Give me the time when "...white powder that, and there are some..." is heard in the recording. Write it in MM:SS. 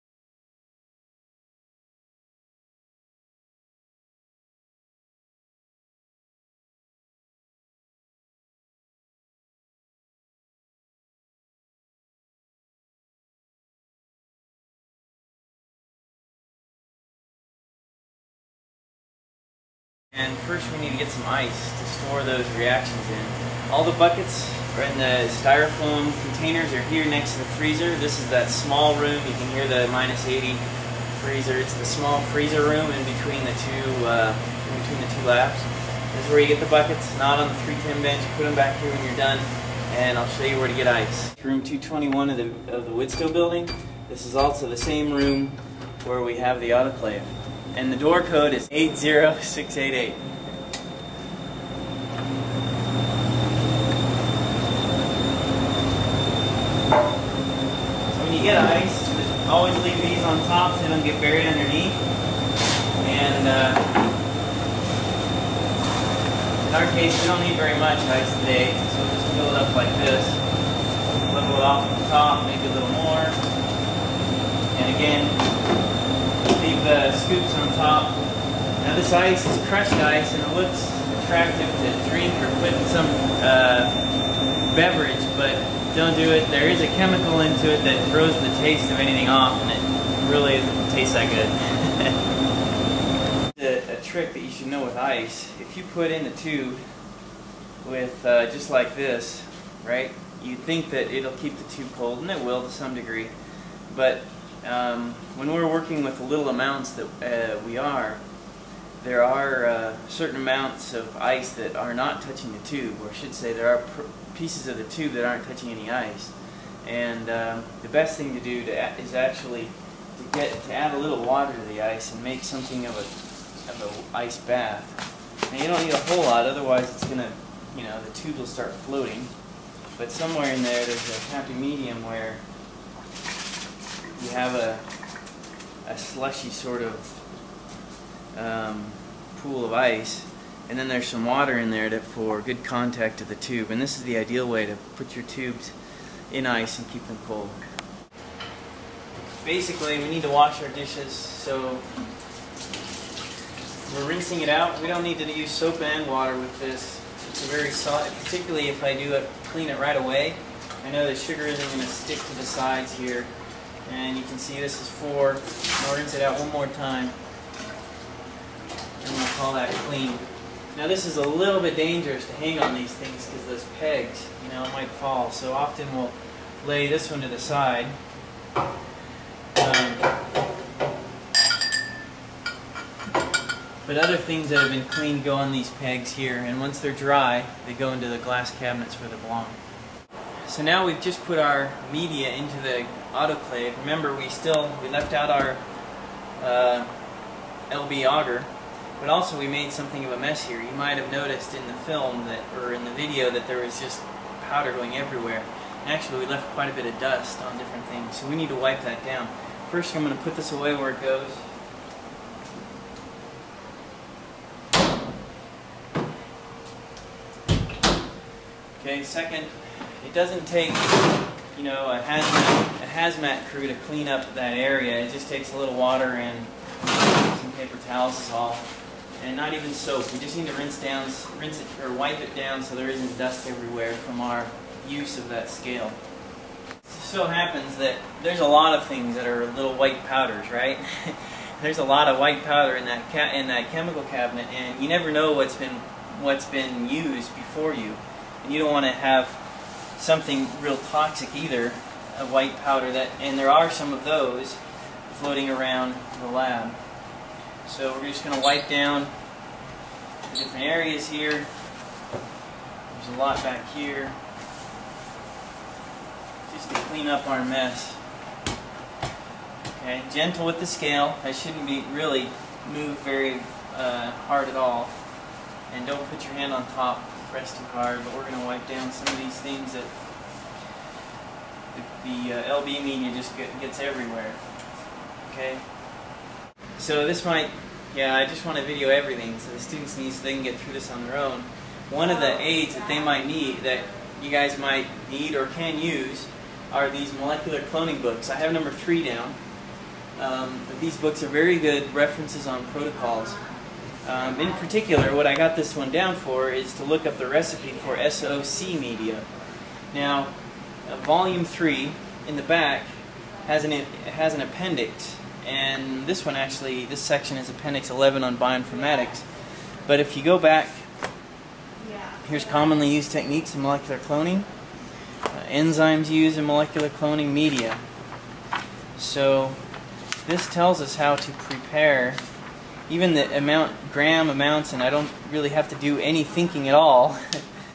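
04:12.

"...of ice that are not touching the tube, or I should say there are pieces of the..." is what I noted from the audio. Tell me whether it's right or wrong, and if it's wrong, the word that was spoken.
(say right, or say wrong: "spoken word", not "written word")
right.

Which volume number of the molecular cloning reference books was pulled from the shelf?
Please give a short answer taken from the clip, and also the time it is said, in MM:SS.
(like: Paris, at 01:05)
3, at 04:58.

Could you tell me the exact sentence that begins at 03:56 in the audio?
It so happens that there's a lot of things that are little white powders, right?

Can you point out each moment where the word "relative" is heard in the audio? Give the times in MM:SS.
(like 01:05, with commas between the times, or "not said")
not said.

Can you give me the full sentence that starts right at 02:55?
So often we'll lay this one to the side.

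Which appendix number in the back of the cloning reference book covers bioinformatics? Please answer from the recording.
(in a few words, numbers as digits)
11.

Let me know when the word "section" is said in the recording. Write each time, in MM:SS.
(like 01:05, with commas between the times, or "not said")
05:16.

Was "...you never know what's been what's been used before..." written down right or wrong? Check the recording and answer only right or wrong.
right.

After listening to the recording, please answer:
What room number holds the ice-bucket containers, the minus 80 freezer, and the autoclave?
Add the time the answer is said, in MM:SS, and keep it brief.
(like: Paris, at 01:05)
221, at 00:41.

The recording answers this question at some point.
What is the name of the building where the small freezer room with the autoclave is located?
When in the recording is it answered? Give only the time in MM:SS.
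00:42.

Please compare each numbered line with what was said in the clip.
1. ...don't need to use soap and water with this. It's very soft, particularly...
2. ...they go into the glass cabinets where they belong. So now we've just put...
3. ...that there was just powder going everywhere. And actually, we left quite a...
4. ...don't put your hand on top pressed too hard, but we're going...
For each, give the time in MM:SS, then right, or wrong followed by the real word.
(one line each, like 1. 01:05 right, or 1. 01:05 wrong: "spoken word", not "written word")
1. 02:34 right
2. 03:07 right
3. 03:23 right
4. 04:35 right.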